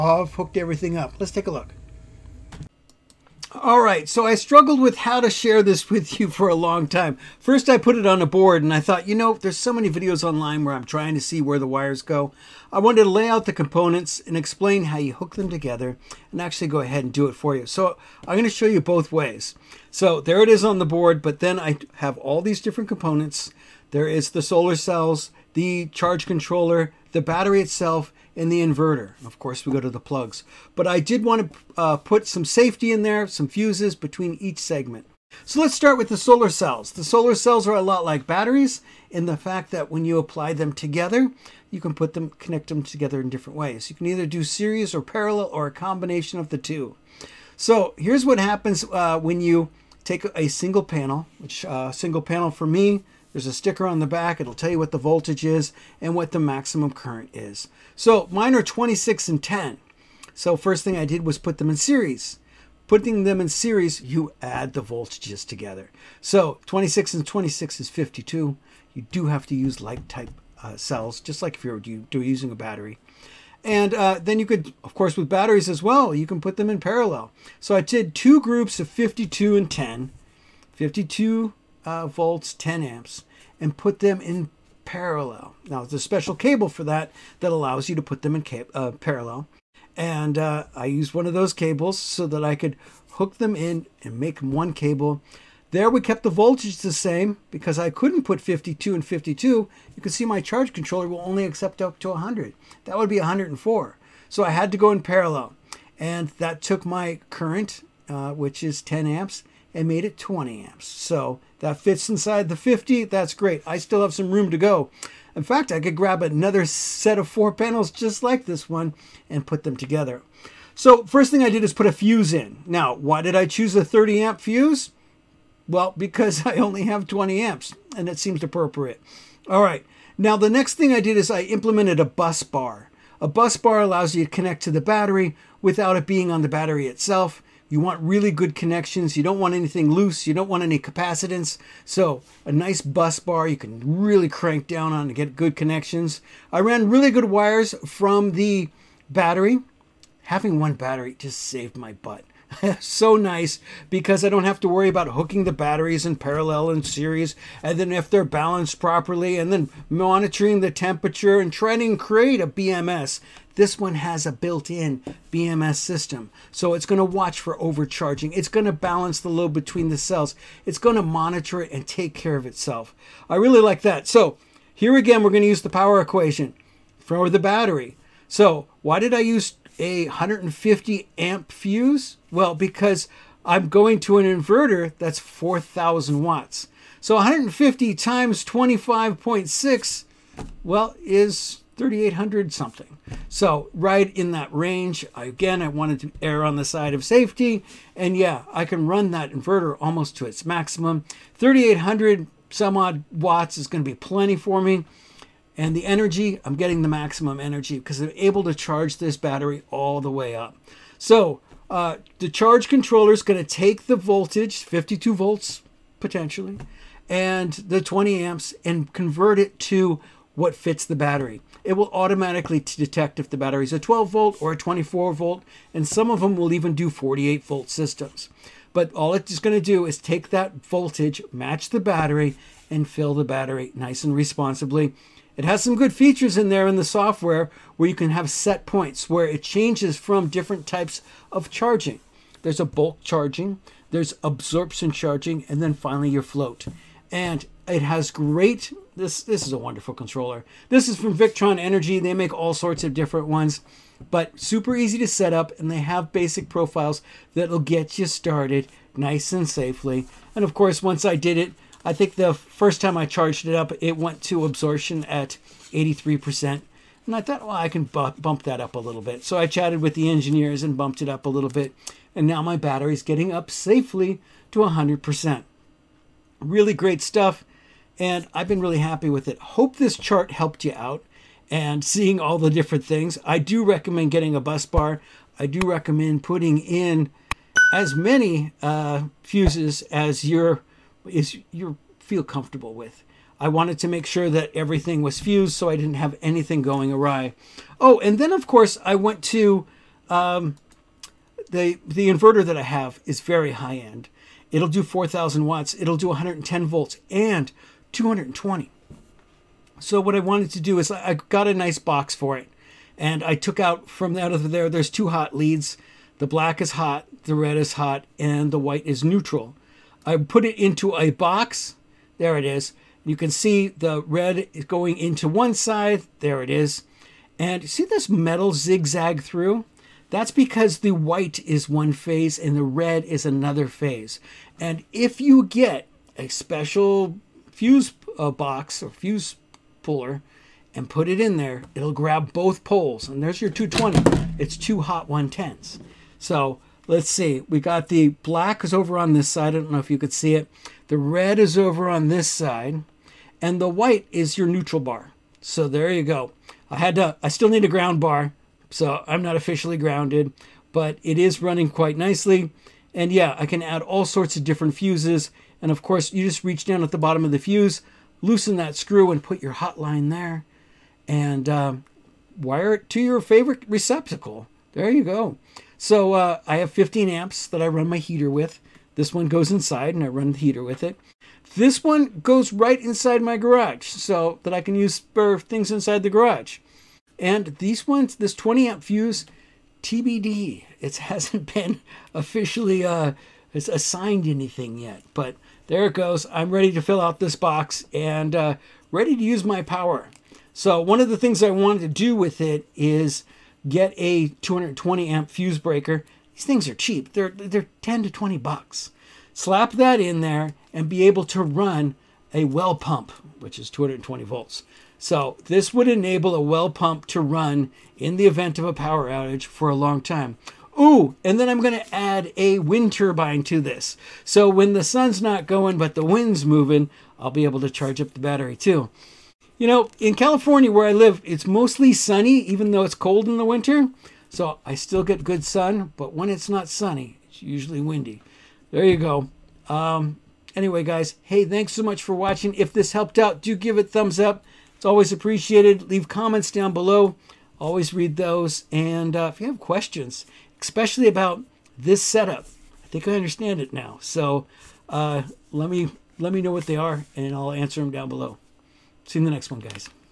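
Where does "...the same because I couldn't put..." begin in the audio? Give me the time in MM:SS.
01:36.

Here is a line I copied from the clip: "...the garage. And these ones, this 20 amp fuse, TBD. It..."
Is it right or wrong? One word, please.
right.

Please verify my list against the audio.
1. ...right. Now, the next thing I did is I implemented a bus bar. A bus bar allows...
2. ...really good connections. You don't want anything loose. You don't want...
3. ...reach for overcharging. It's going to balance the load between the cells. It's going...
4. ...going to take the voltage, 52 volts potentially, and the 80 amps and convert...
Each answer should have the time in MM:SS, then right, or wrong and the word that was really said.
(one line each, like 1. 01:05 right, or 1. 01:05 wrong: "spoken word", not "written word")
1. 02:09 right
2. 02:18 right
3. 02:47 wrong: "watch", not "reach"
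4. 03:33 wrong: "20", not "80".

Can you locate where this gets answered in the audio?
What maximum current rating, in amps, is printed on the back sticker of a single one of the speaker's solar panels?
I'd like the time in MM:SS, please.
00:58.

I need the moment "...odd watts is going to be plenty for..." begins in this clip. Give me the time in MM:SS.
03:22.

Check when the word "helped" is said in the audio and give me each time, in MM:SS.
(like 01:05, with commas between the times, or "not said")
04:40, 07:22.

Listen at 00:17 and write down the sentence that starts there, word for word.
So I'm going to show you both ways.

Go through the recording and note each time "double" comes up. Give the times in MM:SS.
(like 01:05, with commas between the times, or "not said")
not said.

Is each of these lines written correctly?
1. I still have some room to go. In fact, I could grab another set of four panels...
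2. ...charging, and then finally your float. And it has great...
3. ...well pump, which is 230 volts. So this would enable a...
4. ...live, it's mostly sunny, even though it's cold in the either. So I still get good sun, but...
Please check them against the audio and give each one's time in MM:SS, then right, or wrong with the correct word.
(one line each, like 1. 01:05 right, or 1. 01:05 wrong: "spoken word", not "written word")
1. 01:53 right
2. 04:04 right
3. 06:52 wrong: "220", not "230"
4. 07:10 wrong: "winter", not "either".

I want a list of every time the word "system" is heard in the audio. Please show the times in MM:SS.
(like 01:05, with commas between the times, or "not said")
02:45, 03:47.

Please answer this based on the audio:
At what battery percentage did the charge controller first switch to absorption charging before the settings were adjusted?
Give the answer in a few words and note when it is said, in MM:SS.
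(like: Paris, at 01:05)
83%, at 04:25.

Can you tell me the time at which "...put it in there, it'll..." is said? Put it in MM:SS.
05:40.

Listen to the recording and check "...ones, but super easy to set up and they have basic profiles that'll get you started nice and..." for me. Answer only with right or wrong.
right.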